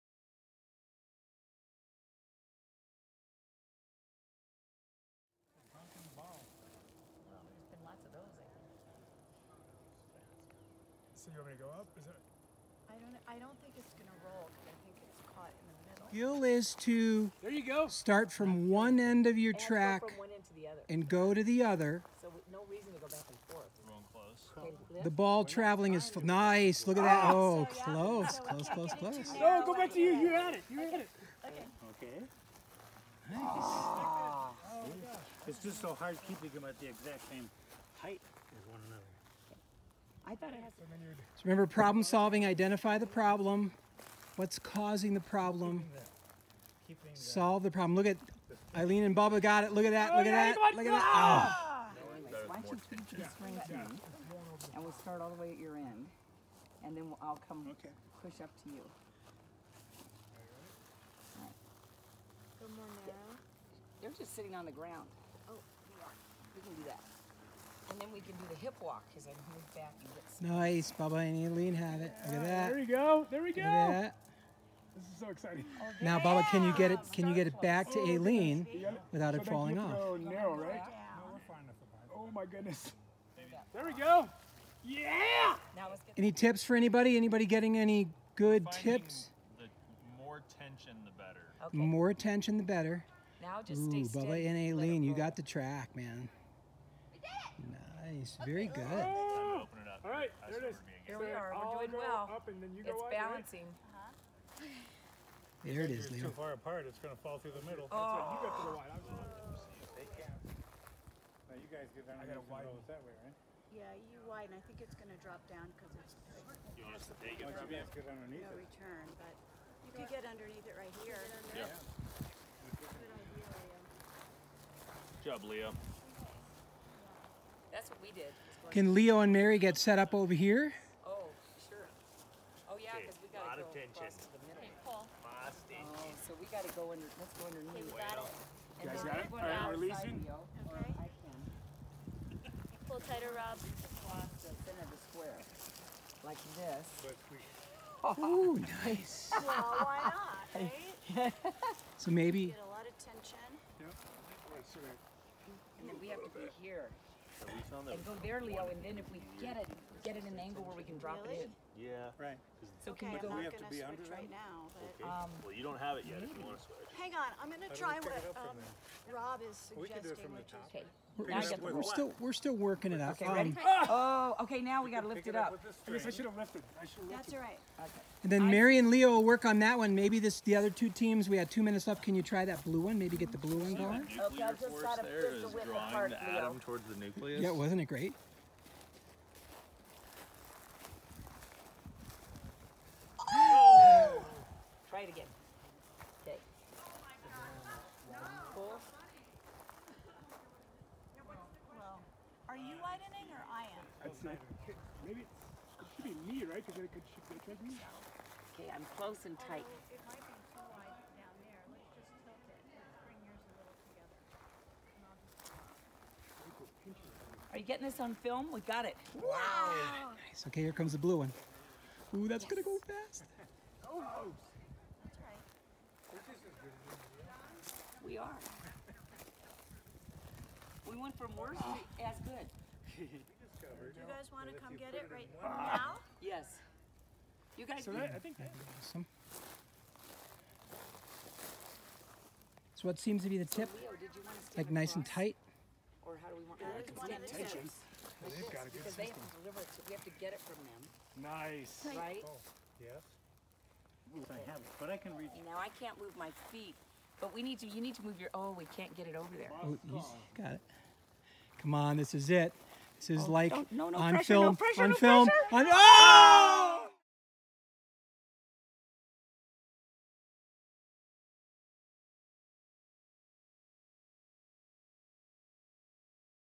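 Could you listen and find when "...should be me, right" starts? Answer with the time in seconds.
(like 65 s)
205 s.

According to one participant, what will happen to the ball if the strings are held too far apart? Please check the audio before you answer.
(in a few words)
Fall through the middle.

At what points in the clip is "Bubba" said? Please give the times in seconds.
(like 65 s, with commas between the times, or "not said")
49 s, 70 s, 76 s, 94 s.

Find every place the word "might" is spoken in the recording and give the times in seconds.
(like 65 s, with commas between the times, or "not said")
210 s.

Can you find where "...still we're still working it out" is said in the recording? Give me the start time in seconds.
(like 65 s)
171 s.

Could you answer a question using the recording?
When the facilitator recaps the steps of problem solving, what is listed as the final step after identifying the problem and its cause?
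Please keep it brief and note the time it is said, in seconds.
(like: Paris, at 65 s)
Solve the problem, at 47 s.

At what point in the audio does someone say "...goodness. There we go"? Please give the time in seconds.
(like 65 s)
82 s.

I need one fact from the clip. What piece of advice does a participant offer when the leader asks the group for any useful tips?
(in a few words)
The more tension, the better.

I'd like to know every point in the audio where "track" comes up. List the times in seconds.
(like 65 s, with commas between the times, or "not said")
19 s, 95 s.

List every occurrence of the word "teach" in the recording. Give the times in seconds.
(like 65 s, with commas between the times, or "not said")
52 s.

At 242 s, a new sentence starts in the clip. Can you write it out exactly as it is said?
So what seems to be the tip, so Leo, like nice and tight.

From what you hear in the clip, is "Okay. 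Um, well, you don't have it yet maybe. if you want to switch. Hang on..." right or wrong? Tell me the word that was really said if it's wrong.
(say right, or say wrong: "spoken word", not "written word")
right.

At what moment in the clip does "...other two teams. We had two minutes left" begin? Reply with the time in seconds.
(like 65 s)
180 s.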